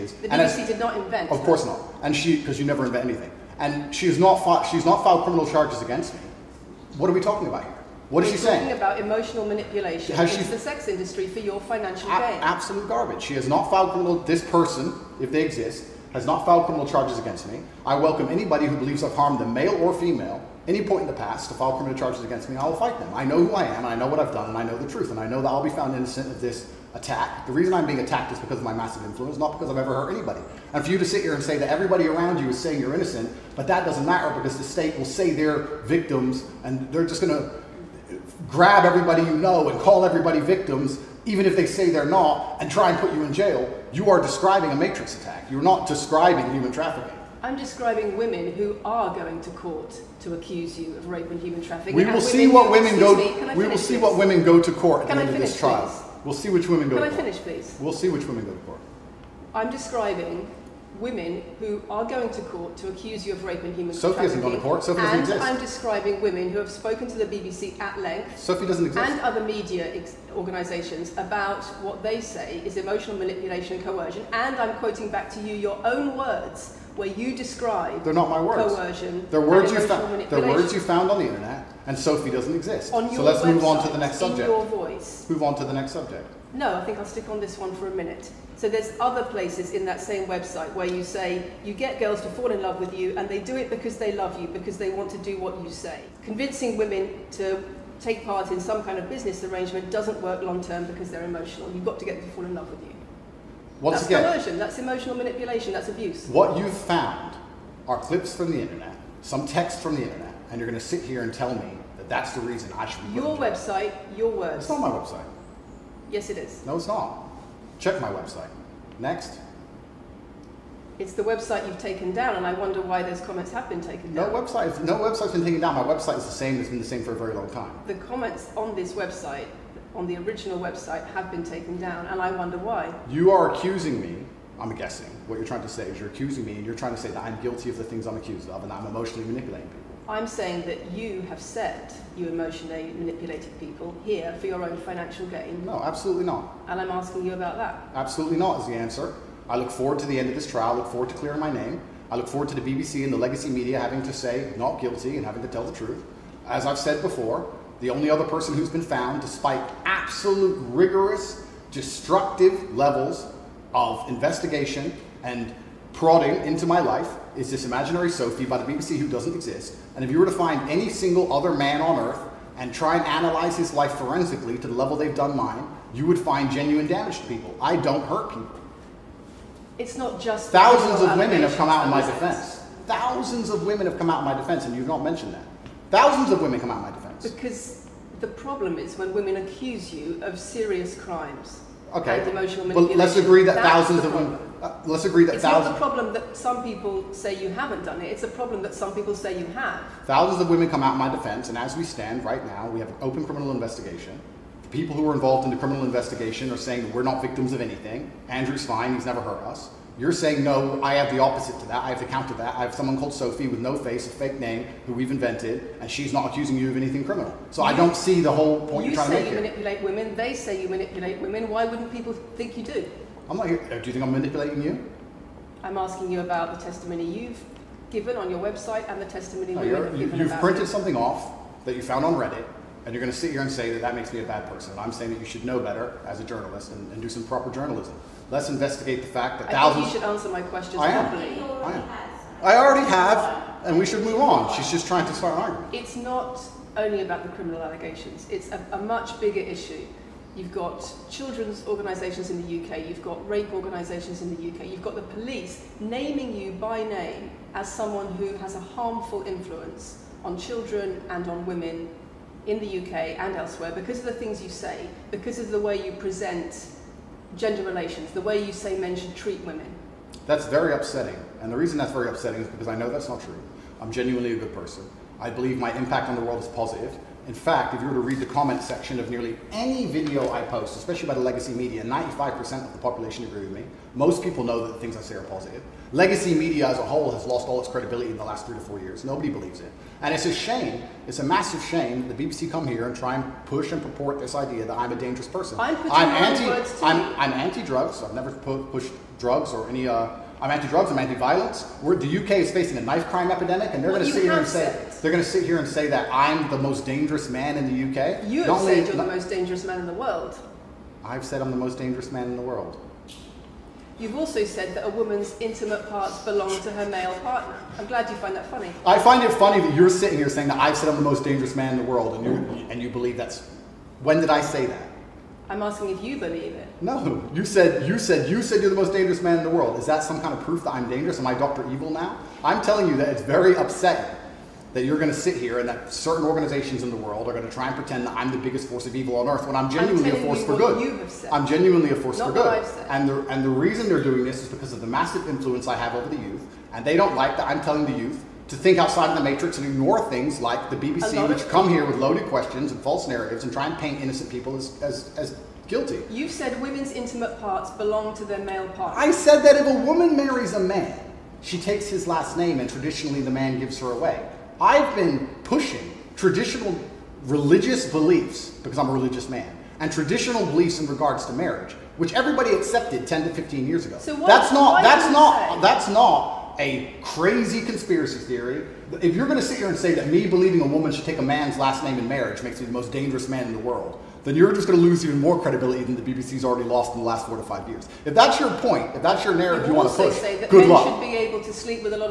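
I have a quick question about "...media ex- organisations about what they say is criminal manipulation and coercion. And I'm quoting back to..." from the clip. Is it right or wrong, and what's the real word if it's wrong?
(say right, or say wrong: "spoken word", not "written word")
wrong: "emotional", not "criminal".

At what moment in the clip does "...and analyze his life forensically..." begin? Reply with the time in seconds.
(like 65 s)
172 s.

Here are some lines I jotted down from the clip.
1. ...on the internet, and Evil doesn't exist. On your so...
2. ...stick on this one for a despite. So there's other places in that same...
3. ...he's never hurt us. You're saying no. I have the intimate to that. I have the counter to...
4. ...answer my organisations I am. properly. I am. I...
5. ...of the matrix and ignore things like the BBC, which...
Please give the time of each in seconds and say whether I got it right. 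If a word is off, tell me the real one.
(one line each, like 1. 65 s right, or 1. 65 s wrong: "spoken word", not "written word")
1. 81 s wrong: "Sophie", not "Evil"
2. 87 s wrong: "minute", not "despite"
3. 208 s wrong: "opposite", not "intimate"
4. 240 s wrong: "questions", not "organisations"
5. 349 s right.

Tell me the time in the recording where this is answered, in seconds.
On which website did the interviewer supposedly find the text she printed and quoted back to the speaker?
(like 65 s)
232 s.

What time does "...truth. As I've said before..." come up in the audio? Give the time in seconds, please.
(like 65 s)
155 s.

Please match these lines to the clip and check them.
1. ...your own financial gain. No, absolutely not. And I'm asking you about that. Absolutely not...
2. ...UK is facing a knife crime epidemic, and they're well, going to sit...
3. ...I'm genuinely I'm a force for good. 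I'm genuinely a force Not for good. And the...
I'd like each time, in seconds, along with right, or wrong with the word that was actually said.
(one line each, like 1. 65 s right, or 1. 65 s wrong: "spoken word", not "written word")
1. 144 s right
2. 302 s right
3. 339 s right.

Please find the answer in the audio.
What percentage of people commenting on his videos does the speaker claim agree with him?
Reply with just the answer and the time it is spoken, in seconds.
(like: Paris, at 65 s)
95%, at 281 s.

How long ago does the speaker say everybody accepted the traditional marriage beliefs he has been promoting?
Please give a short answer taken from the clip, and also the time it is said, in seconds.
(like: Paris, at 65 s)
10 to 15 years, at 373 s.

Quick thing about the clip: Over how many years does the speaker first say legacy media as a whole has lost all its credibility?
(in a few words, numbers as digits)
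three to four years.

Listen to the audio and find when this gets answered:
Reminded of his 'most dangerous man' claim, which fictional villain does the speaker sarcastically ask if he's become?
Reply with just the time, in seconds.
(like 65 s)
331 s.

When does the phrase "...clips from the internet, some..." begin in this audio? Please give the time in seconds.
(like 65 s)
107 s.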